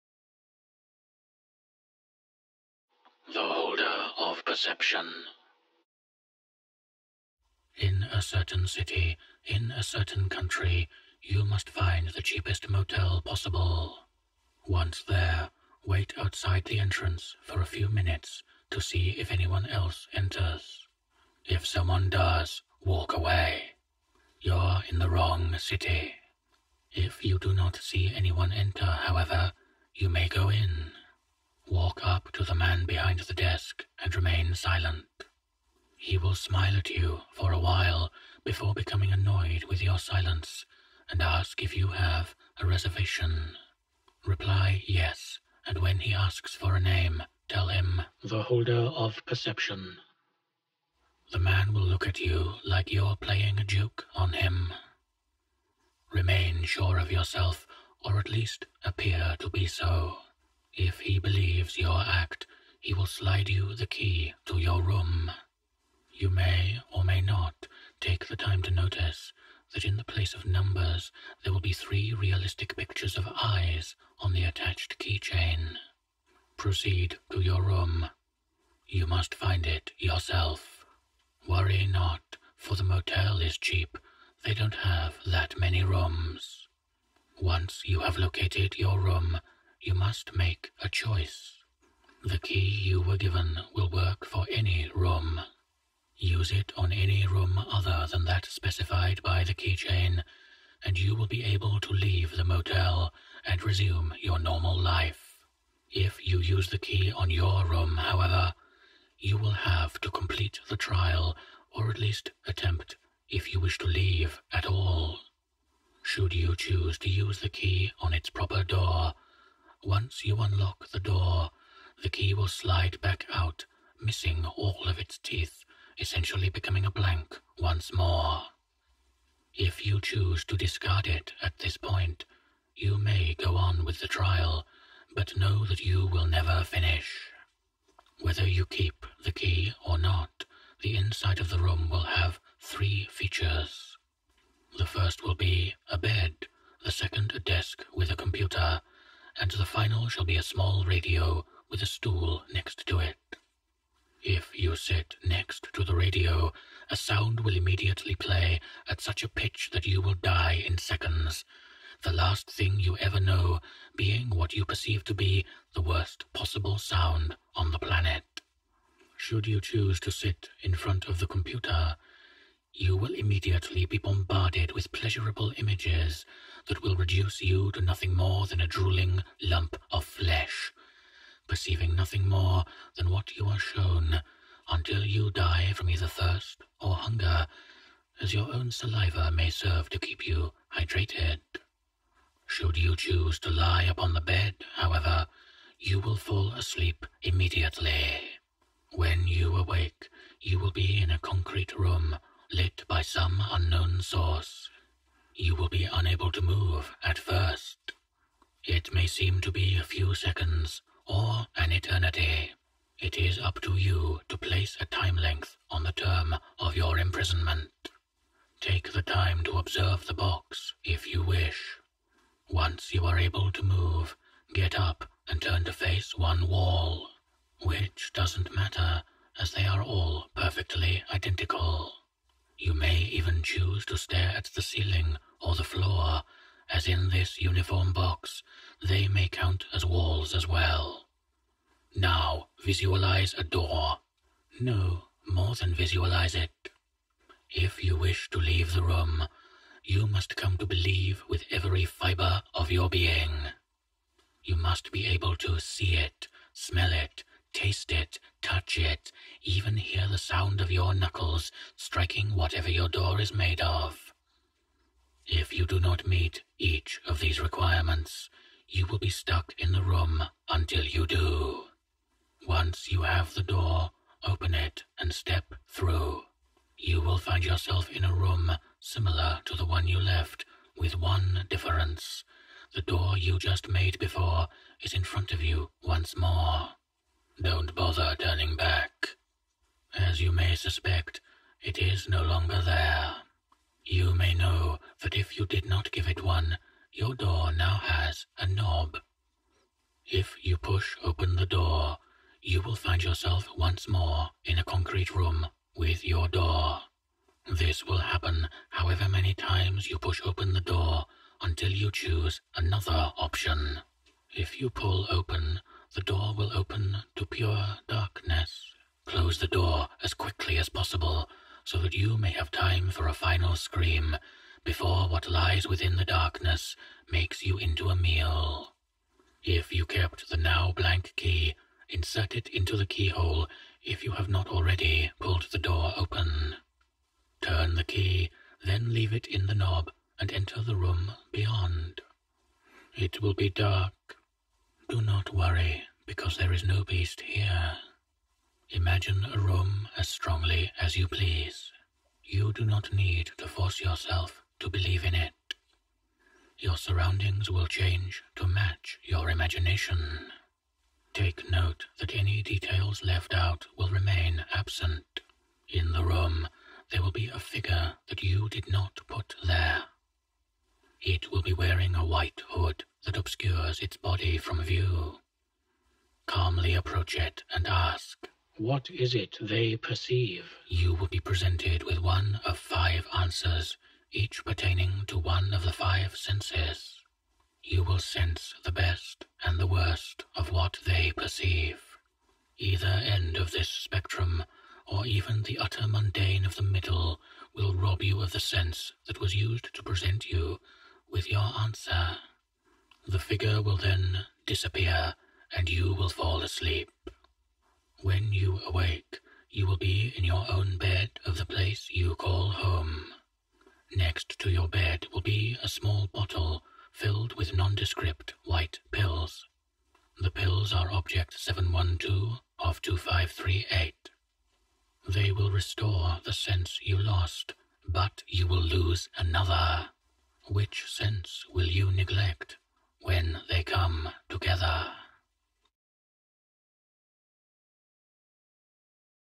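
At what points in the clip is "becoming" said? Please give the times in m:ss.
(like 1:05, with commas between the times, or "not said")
0:38, 2:06.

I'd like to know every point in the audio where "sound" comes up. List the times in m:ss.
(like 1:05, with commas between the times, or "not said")
2:36, 2:46, 4:20.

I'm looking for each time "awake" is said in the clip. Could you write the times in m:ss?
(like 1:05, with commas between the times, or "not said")
3:19, 6:48.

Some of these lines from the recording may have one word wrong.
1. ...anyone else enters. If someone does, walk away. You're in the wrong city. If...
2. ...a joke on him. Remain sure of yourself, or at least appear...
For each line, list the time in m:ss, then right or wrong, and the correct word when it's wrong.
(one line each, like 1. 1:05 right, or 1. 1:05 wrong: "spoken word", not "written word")
1. 0:19 right
2. 0:53 right.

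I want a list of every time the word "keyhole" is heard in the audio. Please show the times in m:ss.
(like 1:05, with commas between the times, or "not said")
5:32.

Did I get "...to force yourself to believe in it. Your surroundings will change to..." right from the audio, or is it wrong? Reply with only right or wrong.
right.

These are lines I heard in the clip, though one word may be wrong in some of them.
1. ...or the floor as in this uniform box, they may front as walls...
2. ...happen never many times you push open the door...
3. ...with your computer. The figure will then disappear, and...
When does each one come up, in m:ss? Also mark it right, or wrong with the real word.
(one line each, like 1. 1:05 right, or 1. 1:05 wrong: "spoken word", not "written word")
1. 3:55 wrong: "count", not "front"
2. 5:07 wrong: "however", not "never"
3. 6:41 wrong: "answer", not "computer".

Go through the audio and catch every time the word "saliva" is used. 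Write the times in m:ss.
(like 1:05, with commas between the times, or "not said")
3:08.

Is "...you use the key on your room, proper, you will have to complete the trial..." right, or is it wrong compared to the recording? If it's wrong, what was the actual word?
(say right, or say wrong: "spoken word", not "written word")
wrong: "however", not "proper".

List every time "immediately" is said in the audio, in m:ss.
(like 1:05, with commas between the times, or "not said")
2:37, 2:53, 3:17.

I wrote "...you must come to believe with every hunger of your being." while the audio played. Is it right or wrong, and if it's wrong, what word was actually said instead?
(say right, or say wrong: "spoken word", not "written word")
wrong: "fiber", not "hunger".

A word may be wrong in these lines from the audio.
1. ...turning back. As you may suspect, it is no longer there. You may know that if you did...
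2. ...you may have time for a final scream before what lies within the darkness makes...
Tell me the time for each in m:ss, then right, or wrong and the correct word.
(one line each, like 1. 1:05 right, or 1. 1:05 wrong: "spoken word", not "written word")
1. 4:48 right
2. 5:21 right.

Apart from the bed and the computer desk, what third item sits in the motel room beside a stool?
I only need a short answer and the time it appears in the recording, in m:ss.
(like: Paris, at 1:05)
A small radio, at 2:30.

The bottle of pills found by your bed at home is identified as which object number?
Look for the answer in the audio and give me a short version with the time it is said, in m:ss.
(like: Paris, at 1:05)
Object 712 of 2538, at 7:00.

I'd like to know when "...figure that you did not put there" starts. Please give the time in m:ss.
6:07.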